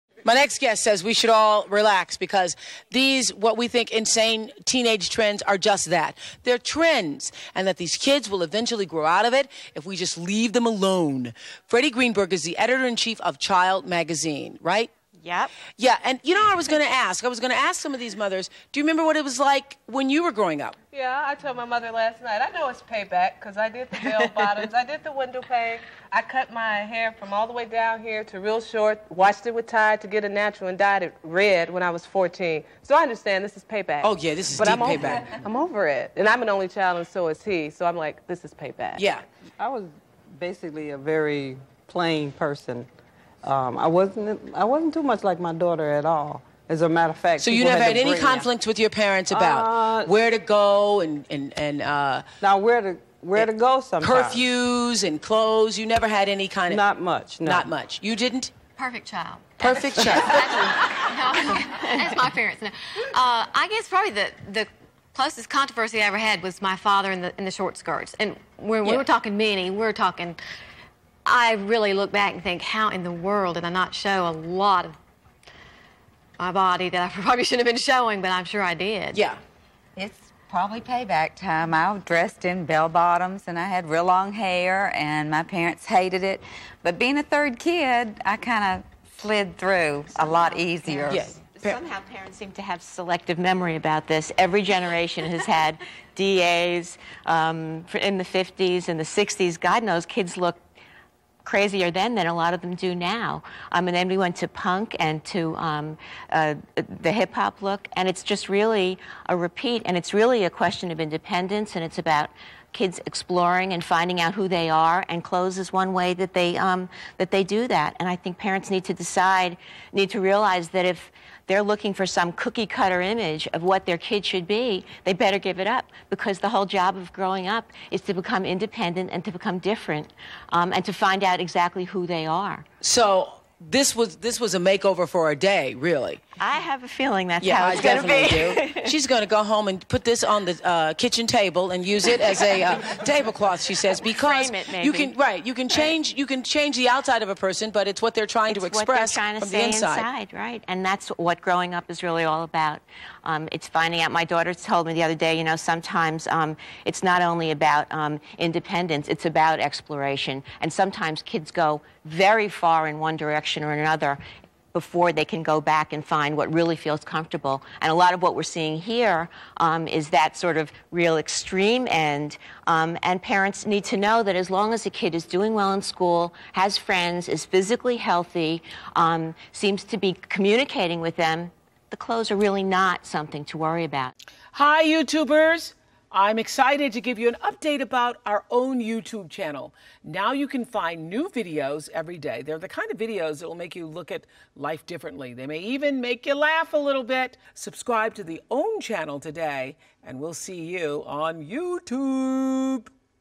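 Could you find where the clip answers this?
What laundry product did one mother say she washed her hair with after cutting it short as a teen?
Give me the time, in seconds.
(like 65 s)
29 s.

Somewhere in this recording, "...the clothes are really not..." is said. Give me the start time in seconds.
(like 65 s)
181 s.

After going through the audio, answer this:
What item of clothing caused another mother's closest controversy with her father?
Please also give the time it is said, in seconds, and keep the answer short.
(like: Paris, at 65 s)
short skirts, at 67 s.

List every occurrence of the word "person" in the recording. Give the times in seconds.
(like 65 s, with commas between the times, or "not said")
42 s, 147 s.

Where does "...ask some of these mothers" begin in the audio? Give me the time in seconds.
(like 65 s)
17 s.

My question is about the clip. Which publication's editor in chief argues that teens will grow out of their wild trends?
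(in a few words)
Child Magazine.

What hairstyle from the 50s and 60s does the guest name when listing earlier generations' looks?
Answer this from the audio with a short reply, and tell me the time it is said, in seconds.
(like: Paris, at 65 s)
DAs, at 96 s.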